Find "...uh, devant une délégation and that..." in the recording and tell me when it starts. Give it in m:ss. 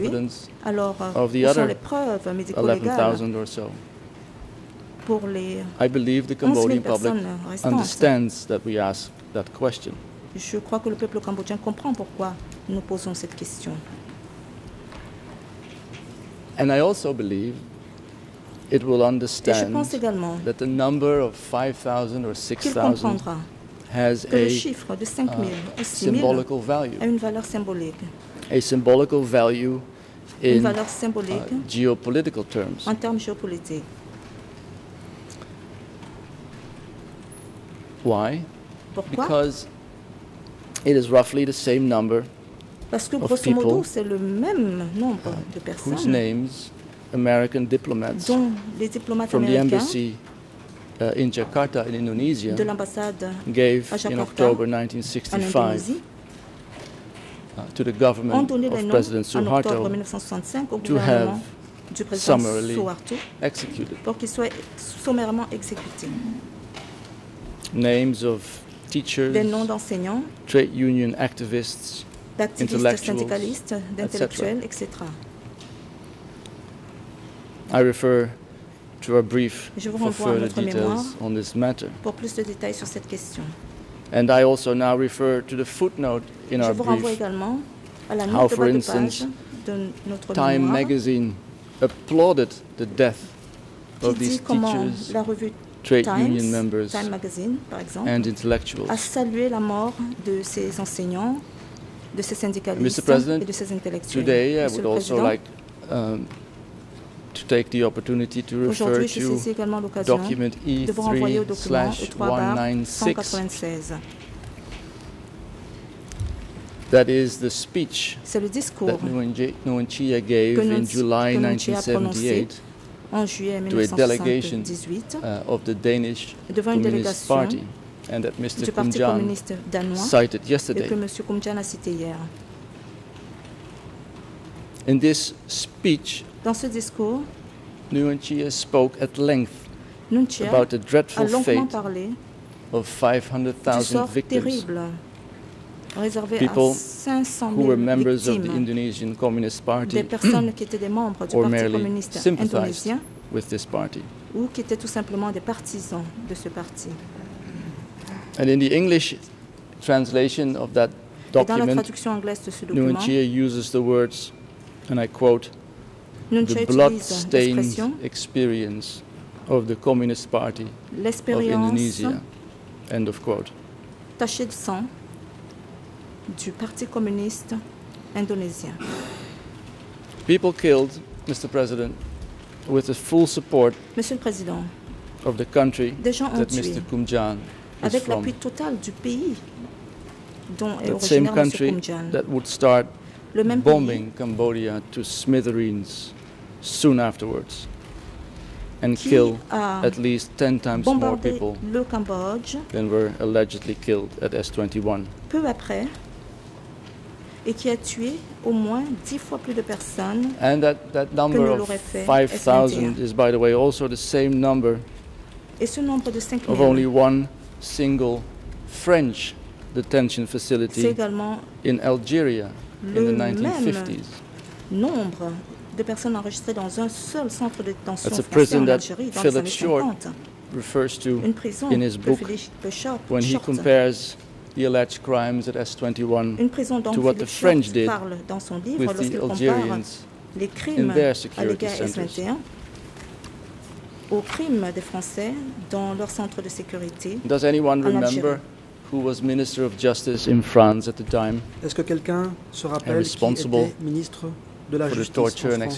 2:05.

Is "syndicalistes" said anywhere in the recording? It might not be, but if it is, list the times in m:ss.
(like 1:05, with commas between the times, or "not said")
1:13, 1:42.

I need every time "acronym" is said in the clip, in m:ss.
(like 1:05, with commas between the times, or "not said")
not said.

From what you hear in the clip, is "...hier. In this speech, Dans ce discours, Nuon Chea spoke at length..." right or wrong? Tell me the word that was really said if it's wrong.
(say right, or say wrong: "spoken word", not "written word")
right.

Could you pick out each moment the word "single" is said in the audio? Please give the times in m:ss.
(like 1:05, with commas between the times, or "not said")
3:37.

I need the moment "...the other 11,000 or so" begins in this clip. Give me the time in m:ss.
0:01.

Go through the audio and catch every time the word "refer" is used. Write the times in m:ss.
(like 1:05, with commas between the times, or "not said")
1:17, 1:24, 1:48, 3:50.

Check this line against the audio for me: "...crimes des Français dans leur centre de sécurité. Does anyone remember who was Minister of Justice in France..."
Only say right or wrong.
right.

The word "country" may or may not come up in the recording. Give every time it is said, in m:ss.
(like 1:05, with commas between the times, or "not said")
3:05, 3:11.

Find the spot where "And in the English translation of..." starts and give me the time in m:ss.
2:38.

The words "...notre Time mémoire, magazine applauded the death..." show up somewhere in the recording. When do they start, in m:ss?
1:30.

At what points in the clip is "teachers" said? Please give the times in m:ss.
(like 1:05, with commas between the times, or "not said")
1:08, 1:34.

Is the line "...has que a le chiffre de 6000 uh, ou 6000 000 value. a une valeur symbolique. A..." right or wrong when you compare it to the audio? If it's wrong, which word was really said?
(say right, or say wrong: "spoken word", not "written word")
wrong: "5000", not "6000".